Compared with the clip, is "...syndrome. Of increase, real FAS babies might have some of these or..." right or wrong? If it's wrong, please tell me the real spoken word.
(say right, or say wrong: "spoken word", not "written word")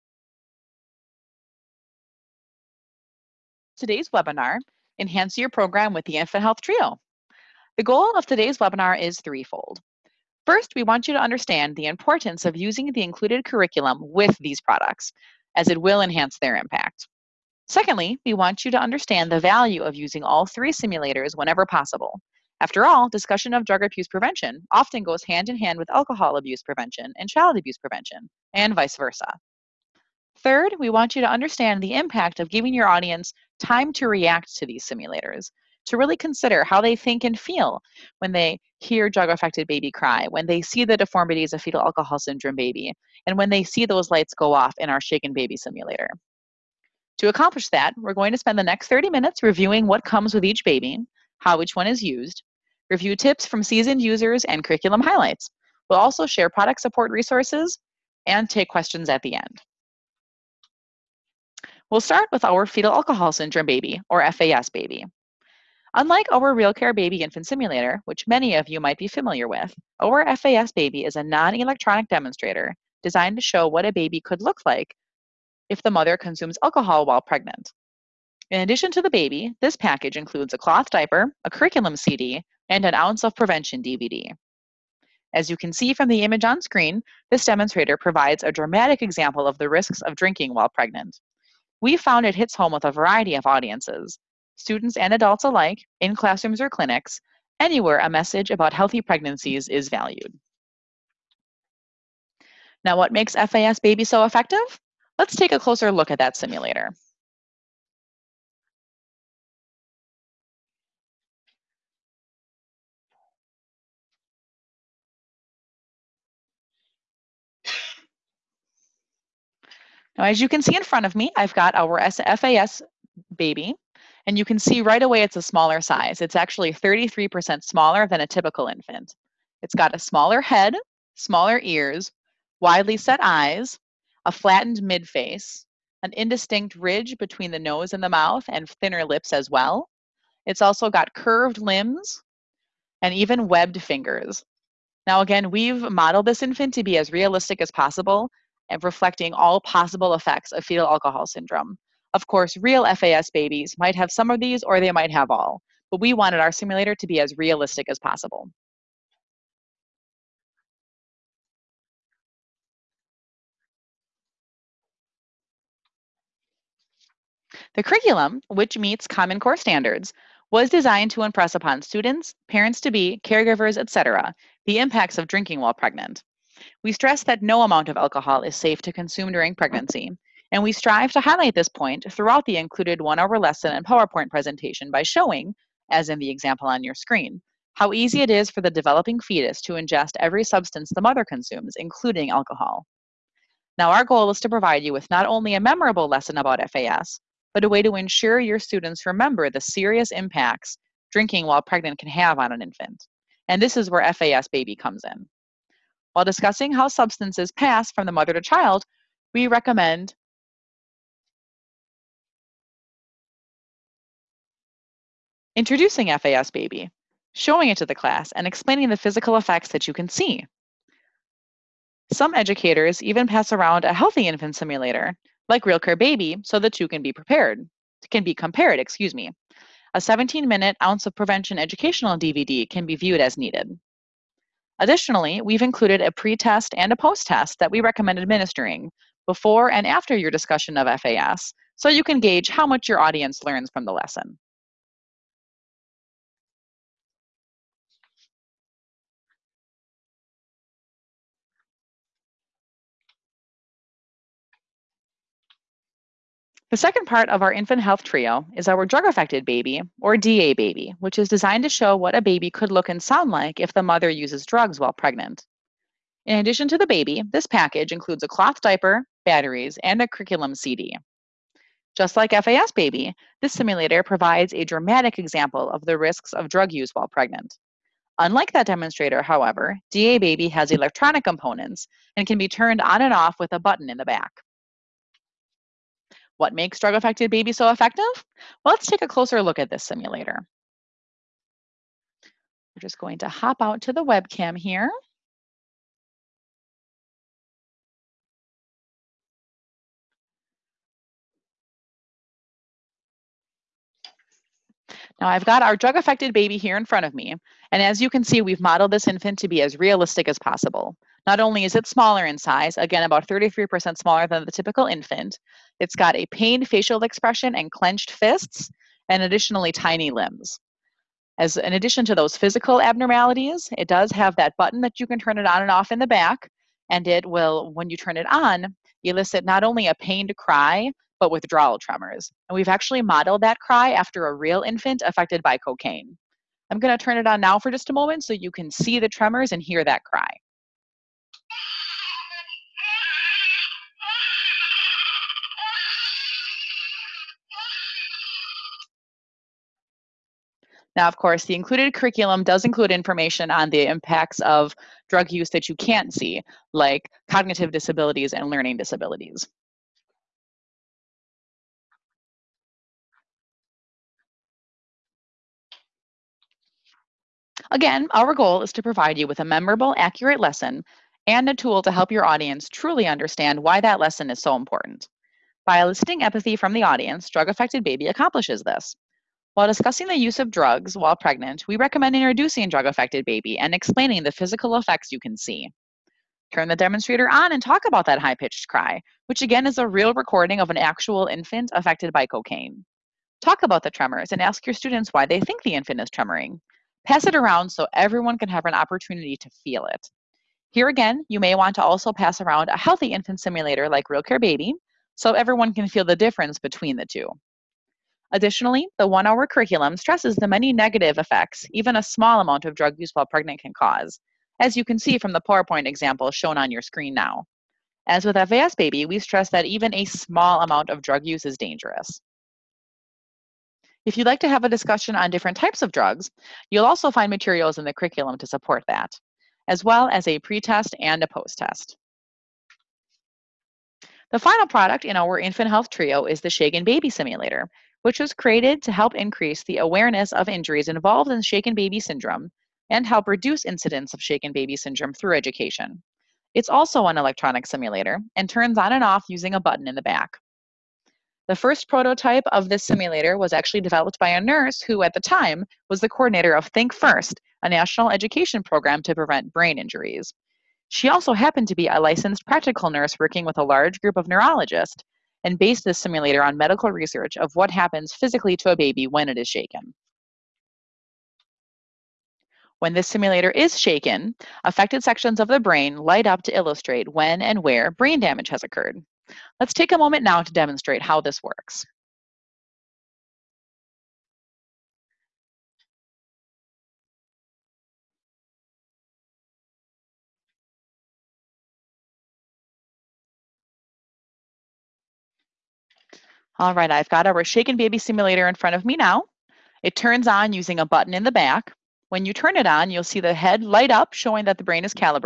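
wrong: "course", not "increase".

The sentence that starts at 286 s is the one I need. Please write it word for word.
What makes drug affected babies so effective?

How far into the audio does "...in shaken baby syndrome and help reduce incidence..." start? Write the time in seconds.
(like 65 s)
441 s.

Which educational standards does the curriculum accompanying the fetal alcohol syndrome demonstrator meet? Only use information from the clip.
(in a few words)
Common Core.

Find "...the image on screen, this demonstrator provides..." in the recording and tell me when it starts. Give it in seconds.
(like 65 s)
86 s.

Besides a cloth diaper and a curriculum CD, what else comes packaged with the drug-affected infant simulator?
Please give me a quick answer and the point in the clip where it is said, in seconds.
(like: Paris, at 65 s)
batteries, at 269 s.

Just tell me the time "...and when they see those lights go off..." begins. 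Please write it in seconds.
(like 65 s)
43 s.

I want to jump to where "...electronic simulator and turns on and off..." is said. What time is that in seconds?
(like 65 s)
447 s.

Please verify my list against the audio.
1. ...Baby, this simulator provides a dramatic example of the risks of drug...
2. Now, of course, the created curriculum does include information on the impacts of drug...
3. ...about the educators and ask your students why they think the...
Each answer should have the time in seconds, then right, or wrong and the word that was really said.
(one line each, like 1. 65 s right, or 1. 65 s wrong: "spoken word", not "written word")
1. 272 s right
2. 350 s wrong: "included", not "created"
3. 393 s wrong: "tremors", not "educators".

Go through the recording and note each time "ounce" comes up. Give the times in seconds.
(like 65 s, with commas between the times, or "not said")
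82 s, 230 s.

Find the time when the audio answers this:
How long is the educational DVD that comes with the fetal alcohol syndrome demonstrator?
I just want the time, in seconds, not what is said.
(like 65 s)
229 s.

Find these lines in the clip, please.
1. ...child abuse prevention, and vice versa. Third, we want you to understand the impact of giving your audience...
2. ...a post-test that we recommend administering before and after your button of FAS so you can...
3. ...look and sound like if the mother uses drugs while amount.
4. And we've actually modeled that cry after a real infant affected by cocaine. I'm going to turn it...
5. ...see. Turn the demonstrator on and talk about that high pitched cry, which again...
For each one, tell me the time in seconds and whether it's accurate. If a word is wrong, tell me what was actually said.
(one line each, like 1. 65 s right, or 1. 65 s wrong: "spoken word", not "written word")
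1. 27 s right
2. 236 s wrong: "discussion", not "button"
3. 262 s wrong: "pregnant", not "amount"
4. 332 s right
5. 385 s right.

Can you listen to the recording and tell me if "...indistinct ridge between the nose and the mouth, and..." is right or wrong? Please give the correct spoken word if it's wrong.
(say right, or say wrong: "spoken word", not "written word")
right.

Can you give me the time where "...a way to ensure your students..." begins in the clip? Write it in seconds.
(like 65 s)
197 s.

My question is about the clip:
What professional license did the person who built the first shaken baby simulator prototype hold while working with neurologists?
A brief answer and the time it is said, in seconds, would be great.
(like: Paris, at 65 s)
licensed practical nurse, at 461 s.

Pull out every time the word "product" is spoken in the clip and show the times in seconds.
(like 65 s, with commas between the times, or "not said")
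14 s, 56 s, 434 s.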